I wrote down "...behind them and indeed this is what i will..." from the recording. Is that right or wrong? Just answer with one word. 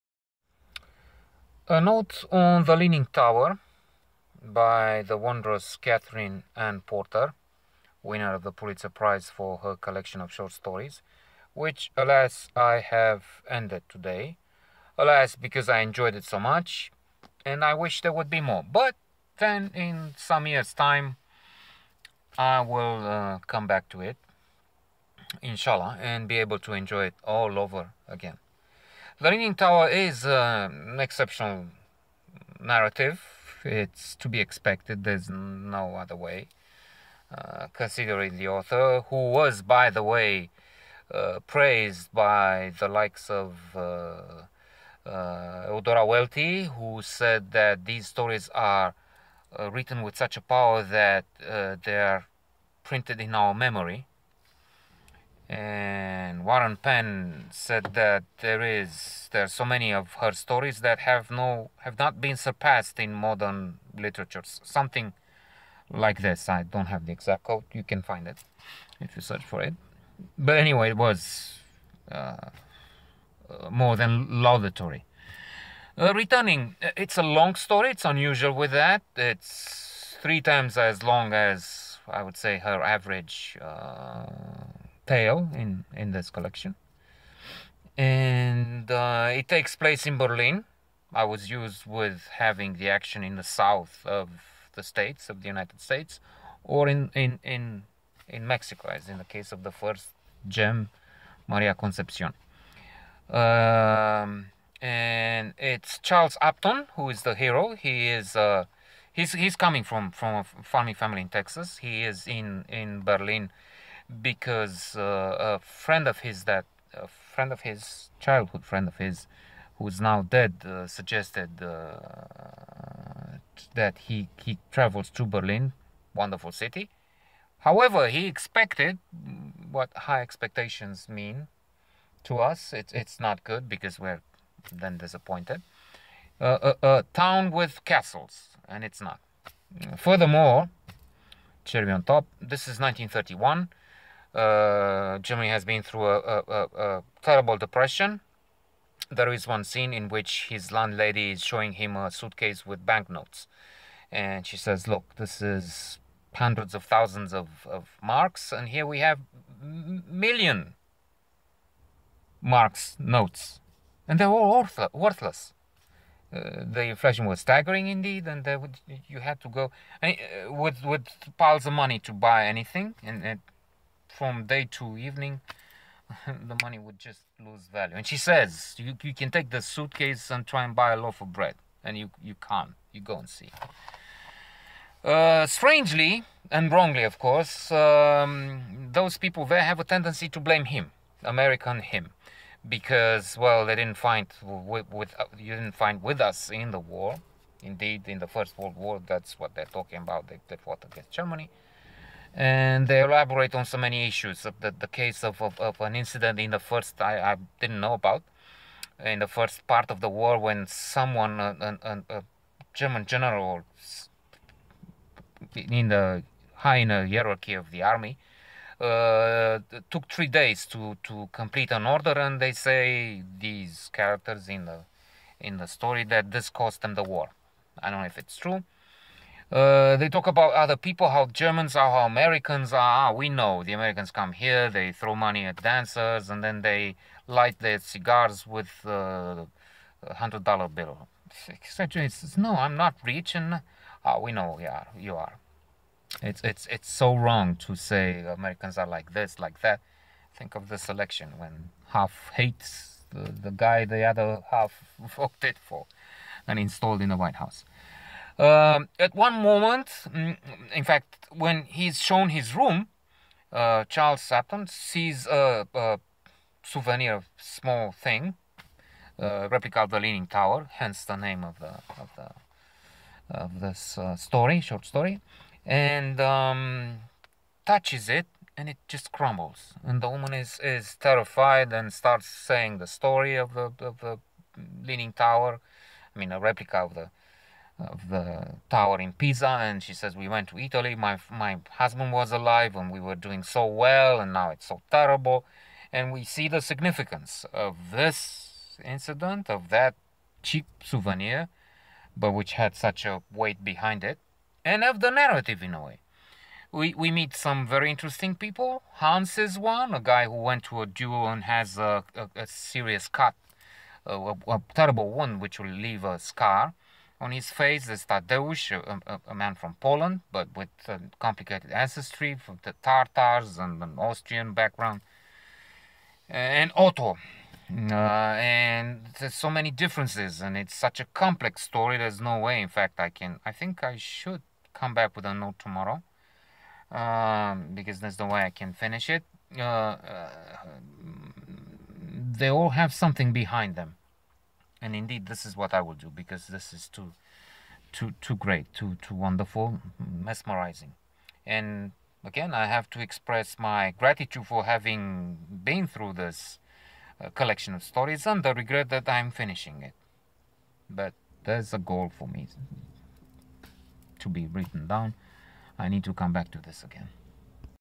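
right.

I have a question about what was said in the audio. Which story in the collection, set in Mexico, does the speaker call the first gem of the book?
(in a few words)
Maria Concepcion.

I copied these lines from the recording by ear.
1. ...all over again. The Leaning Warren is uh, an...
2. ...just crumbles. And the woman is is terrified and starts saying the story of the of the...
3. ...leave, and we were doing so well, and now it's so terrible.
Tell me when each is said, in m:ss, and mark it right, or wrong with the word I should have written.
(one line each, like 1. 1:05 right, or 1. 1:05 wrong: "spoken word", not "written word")
1. 0:27 wrong: "Tower", not "Warren"
2. 4:38 right
3. 4:52 wrong: "alive", not "leave".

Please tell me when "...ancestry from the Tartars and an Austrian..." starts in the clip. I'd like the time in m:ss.
5:21.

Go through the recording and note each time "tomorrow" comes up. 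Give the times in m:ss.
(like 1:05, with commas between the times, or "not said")
5:35.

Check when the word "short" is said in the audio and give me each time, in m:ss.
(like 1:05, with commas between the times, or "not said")
0:10, 4:34.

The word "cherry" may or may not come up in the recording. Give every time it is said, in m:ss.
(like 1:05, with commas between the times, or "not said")
2:21.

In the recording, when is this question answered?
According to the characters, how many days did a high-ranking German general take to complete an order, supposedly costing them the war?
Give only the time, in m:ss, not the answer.
3:40.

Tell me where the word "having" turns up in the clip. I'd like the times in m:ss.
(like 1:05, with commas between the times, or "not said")
1:32, 5:54.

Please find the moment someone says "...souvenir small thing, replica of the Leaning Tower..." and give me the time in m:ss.
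4:26.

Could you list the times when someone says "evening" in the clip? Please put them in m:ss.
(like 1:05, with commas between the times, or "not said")
2:54.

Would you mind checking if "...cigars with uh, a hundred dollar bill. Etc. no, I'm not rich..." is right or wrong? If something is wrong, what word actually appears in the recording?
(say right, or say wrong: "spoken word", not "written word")
right.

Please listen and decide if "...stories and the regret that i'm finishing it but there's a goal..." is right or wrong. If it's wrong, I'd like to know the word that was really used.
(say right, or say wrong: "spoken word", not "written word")
right.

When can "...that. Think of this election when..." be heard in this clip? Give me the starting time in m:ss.
4:09.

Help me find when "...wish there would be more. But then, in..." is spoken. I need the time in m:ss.
0:17.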